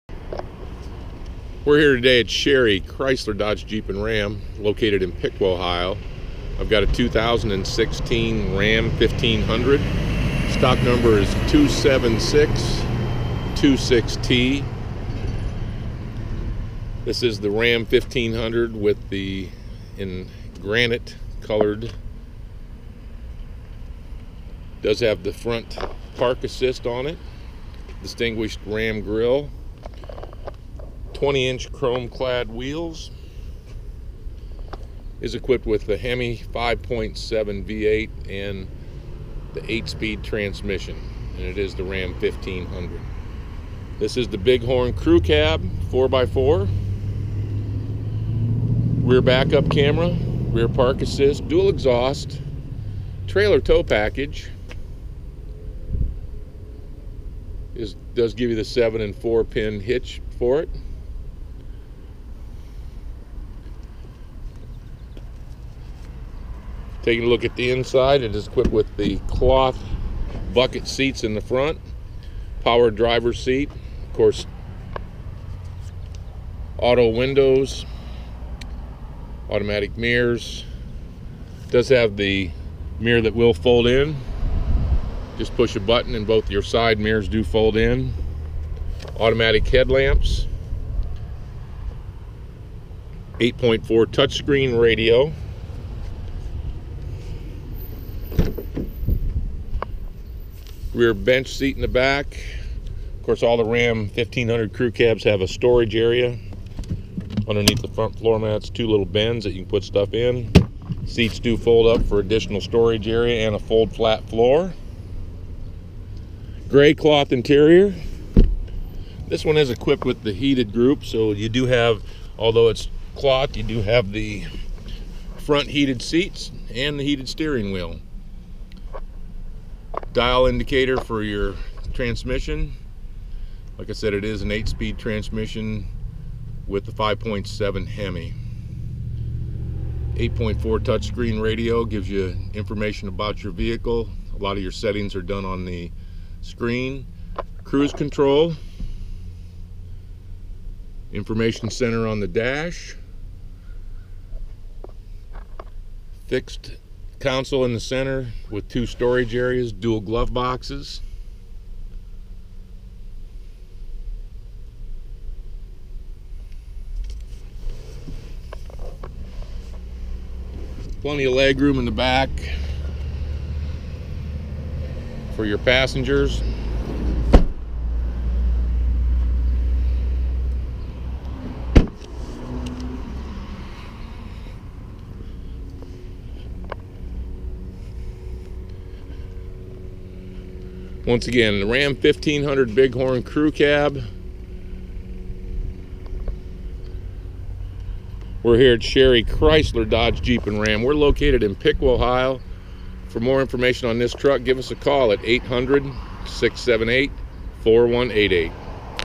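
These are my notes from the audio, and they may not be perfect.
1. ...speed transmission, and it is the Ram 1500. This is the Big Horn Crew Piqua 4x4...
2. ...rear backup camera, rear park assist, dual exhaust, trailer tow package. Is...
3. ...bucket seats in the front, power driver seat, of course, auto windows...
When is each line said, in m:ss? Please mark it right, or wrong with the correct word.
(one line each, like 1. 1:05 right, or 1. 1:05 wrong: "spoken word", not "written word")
1. 0:39 wrong: "Cab", not "Piqua"
2. 0:49 right
3. 1:10 right.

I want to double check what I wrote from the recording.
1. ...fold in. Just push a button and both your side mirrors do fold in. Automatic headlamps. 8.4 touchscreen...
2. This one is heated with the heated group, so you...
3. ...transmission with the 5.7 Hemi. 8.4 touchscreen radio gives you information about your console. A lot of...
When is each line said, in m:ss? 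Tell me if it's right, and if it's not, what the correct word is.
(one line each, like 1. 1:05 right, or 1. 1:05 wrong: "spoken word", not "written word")
1. 1:23 right
2. 1:59 wrong: "equipped", not "heated"
3. 2:14 wrong: "vehicle", not "console".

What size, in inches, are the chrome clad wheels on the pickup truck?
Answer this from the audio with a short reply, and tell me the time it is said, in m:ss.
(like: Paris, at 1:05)
20, at 0:31.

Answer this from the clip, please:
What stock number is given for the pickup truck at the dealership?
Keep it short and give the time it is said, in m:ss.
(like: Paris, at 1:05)
27626T, at 0:11.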